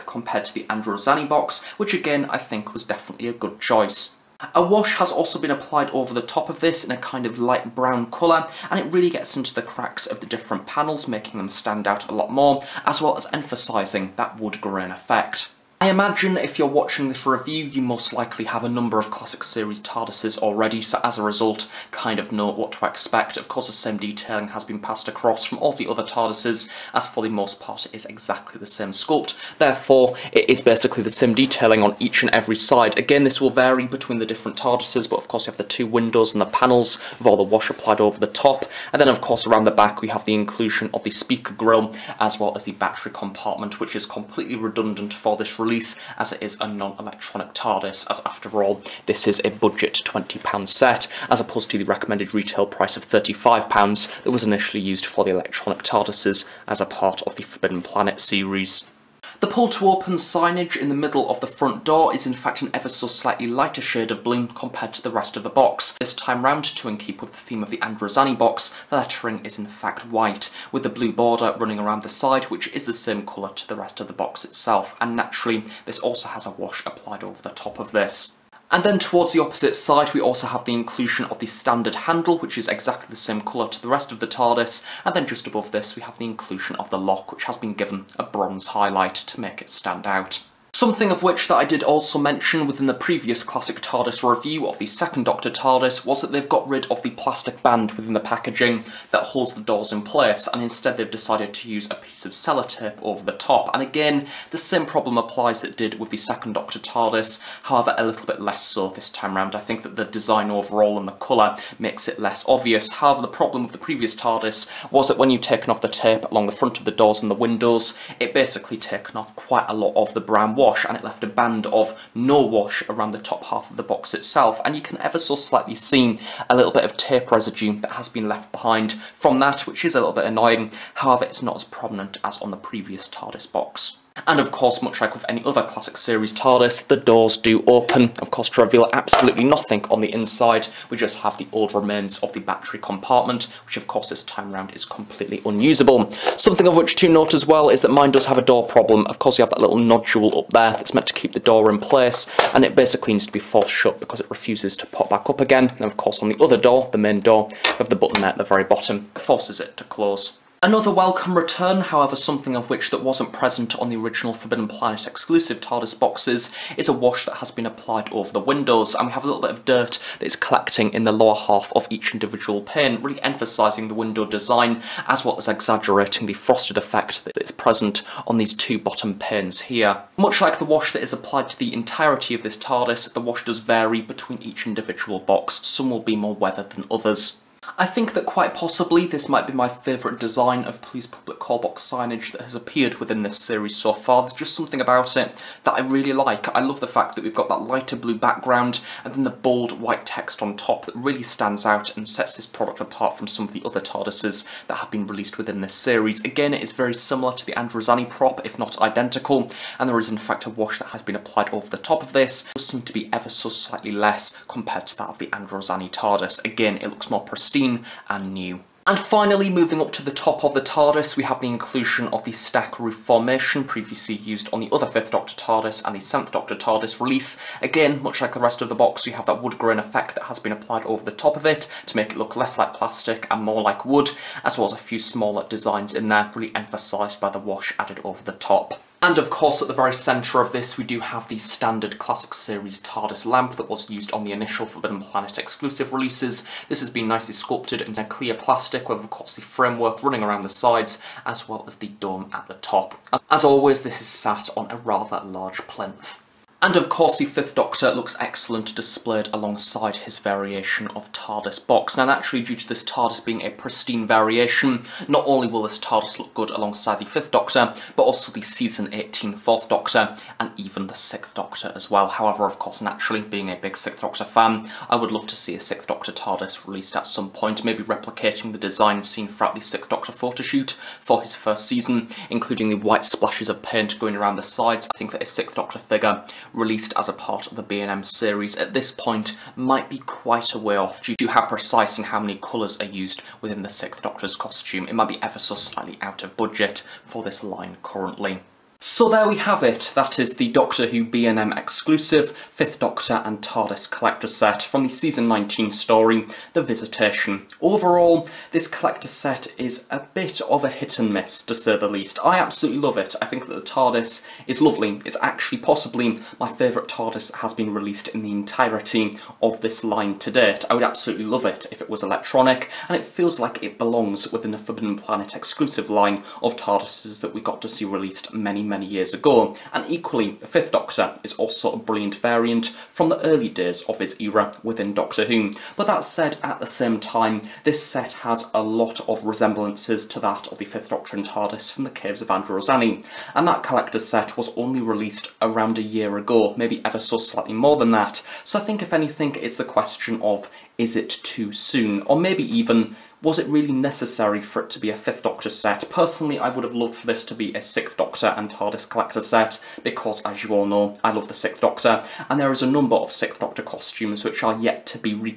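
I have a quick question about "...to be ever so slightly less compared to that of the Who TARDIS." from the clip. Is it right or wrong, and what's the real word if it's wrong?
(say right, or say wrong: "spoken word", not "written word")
wrong: "Androzani", not "Who".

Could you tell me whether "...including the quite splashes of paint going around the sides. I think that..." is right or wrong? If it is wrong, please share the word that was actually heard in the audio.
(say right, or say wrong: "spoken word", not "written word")
wrong: "white", not "quite".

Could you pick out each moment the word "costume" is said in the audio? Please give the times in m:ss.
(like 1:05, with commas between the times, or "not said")
4:54, 6:03.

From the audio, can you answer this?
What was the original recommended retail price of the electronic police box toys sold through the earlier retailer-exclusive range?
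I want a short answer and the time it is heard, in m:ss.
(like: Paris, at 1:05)
£35, at 0:53.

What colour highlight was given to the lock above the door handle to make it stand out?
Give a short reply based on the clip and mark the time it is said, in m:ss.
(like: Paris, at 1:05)
bronze, at 1:28.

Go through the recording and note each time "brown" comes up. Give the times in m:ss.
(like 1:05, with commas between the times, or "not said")
0:07, 2:00.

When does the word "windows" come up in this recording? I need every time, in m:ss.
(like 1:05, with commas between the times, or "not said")
0:35, 1:57, 2:48, 2:53.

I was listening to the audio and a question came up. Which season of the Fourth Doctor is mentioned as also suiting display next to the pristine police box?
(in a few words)
Season 18.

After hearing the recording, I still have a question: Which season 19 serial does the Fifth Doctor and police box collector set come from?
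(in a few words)
The Visitation.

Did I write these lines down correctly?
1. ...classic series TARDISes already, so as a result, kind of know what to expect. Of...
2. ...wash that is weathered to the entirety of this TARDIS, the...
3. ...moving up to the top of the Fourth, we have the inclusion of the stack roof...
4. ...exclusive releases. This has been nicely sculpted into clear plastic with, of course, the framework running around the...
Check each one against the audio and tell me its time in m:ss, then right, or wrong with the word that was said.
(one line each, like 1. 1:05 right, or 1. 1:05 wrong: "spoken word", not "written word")
1. 0:19 right
2. 3:00 wrong: "applied", not "weathered"
3. 3:39 wrong: "TARDIS", not "Fourth"
4. 4:05 right.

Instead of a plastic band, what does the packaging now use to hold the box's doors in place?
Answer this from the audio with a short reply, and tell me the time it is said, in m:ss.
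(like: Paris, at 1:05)
sellotape, at 1:42.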